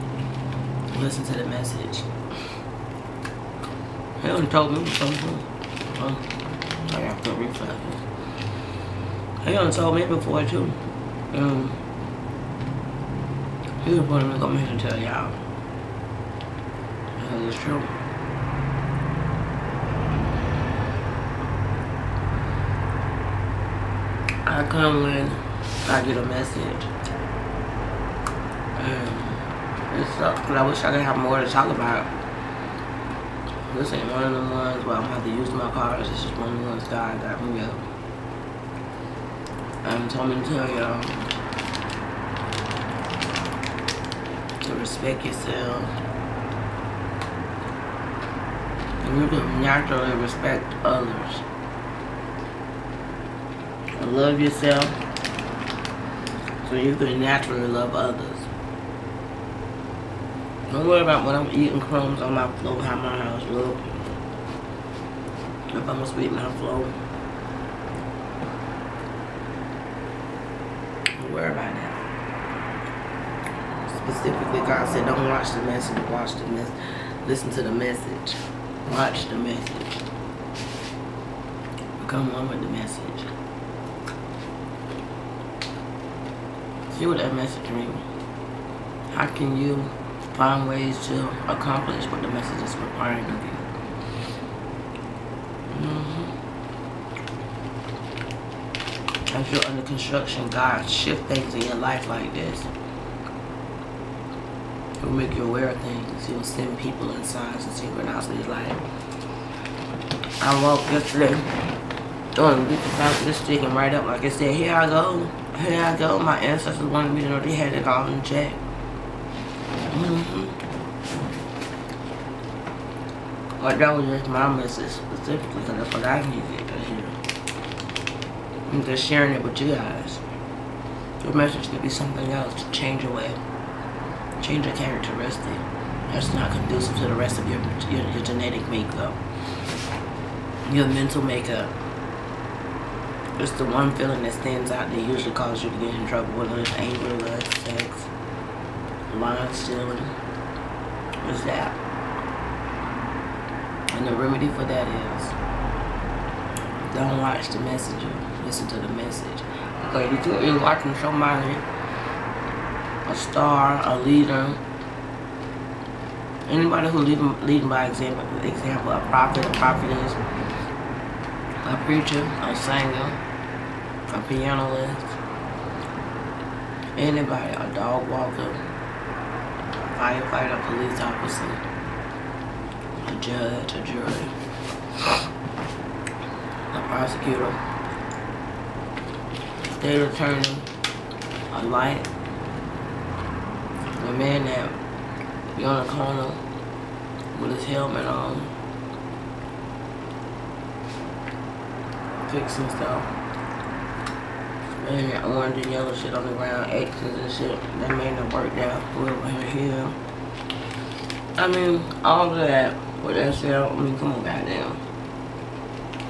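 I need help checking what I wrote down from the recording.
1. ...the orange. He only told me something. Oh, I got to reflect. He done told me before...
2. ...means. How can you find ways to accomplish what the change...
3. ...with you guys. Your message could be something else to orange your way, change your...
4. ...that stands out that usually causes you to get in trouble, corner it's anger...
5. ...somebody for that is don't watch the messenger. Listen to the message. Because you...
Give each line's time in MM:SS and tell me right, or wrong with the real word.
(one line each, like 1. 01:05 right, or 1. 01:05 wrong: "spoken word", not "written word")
1. 00:01 wrong: "message", not "orange"
2. 01:27 wrong: "message", not "change"
3. 02:09 wrong: "change", not "orange"
4. 02:24 wrong: "whether", not "corner"
5. 02:34 wrong: "remedy", not "somebody".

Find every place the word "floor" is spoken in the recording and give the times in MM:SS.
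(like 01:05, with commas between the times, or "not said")
01:02, 01:06.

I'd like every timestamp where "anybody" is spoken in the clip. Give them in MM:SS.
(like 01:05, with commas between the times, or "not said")
02:46, 02:56.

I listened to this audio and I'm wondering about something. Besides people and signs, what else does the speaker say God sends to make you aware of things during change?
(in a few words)
Synchronicities.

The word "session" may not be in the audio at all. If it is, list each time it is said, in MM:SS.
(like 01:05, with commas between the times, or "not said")
not said.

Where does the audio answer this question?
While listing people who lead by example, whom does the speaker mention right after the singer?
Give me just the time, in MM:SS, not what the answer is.
02:54.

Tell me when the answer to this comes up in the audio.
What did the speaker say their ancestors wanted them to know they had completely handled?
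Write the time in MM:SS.
01:57.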